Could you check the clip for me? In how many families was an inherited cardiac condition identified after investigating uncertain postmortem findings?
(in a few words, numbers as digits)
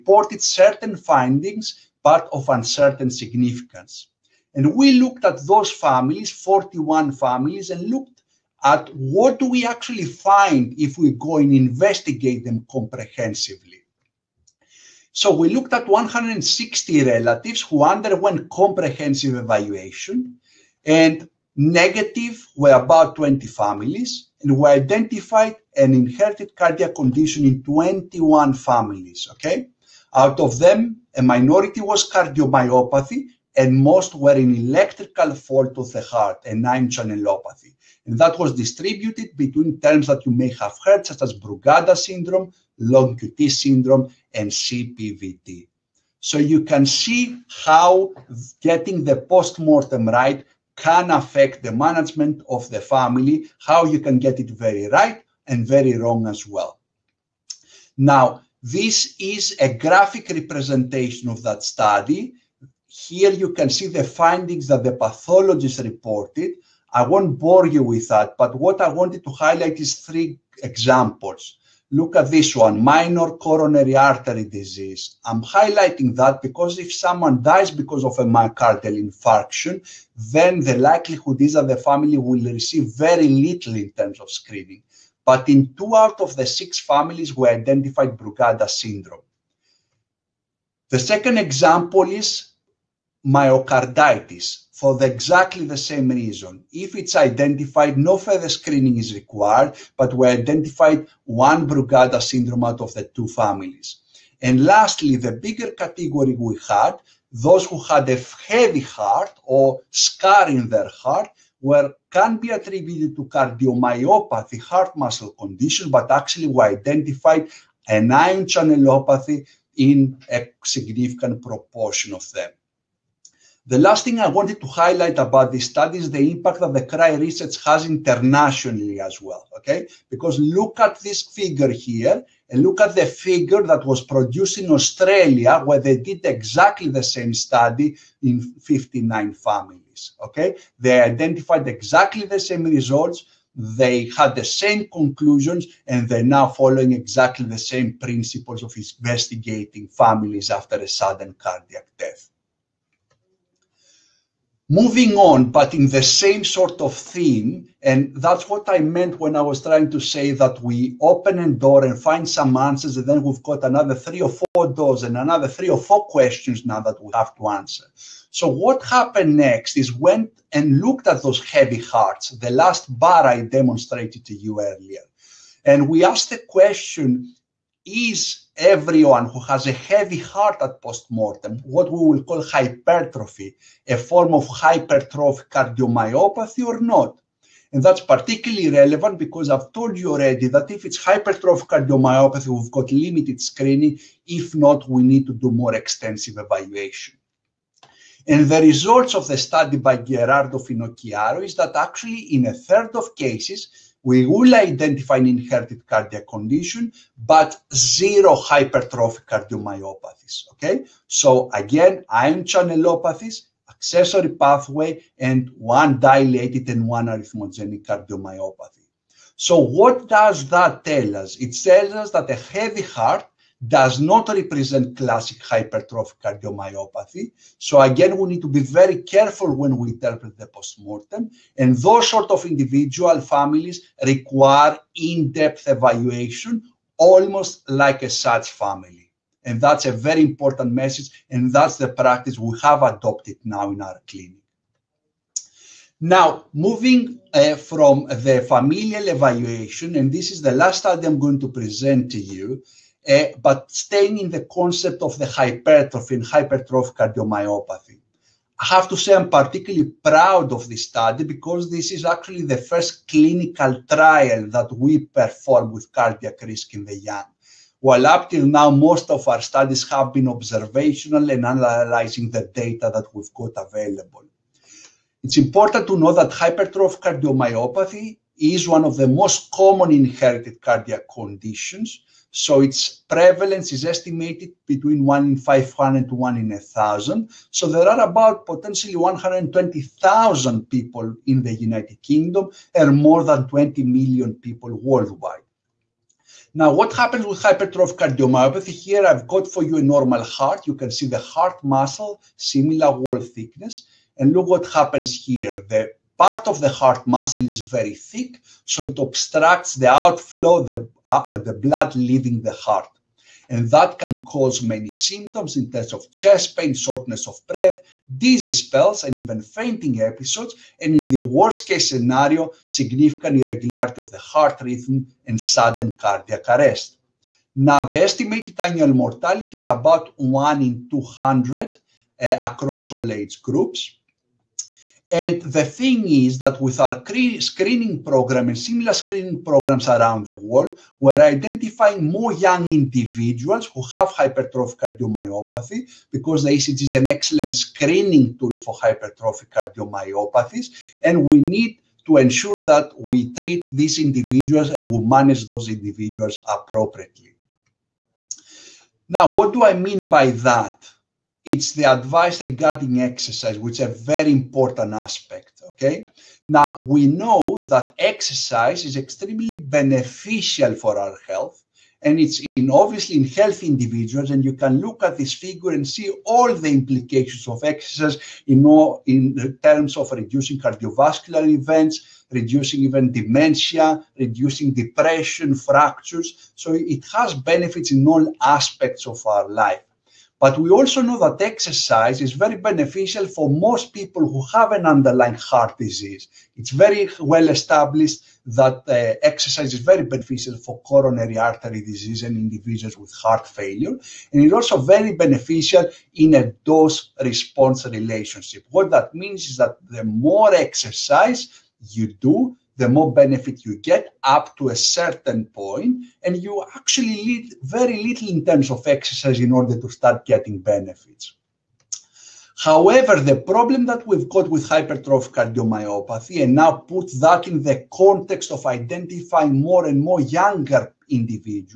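21.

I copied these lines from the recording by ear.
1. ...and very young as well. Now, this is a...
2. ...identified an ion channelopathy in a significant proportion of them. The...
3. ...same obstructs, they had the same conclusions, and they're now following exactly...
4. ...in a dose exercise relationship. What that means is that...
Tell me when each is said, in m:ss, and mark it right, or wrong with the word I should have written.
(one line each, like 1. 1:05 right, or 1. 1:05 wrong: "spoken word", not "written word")
1. 0:55 wrong: "wrong", not "young"
2. 1:56 right
3. 2:22 wrong: "results", not "obstructs"
4. 6:46 wrong: "response", not "exercise".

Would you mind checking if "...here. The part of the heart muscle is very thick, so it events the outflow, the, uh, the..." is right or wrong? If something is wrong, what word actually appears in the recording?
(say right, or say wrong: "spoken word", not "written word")
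wrong: "obstructs", not "events".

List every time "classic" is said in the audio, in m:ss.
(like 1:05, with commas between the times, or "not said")
3:44.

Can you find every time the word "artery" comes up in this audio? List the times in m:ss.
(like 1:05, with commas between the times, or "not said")
1:13, 6:41.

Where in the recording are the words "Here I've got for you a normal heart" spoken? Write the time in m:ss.
4:58.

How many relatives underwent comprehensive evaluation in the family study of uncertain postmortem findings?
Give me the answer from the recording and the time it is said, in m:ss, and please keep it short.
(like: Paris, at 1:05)
160, at 0:15.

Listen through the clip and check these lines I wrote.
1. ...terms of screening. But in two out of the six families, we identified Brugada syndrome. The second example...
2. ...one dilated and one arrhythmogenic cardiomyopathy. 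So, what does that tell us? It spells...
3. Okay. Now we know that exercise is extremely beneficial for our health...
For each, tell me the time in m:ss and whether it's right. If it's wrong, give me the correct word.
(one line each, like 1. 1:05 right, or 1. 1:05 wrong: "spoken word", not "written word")
1. 1:23 right
2. 3:35 wrong: "tells", not "spells"
3. 6:05 right.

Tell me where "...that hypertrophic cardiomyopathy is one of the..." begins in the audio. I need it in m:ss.
4:36.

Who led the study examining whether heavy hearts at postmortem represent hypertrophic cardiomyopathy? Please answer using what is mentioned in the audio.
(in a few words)
Gerardo Finocchiaro.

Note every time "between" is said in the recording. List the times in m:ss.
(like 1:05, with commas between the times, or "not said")
0:39, 4:44.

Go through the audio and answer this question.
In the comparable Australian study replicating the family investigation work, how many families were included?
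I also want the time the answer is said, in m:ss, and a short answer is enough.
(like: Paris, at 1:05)
59, at 2:18.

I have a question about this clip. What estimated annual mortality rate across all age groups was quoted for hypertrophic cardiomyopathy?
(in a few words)
1 in 200.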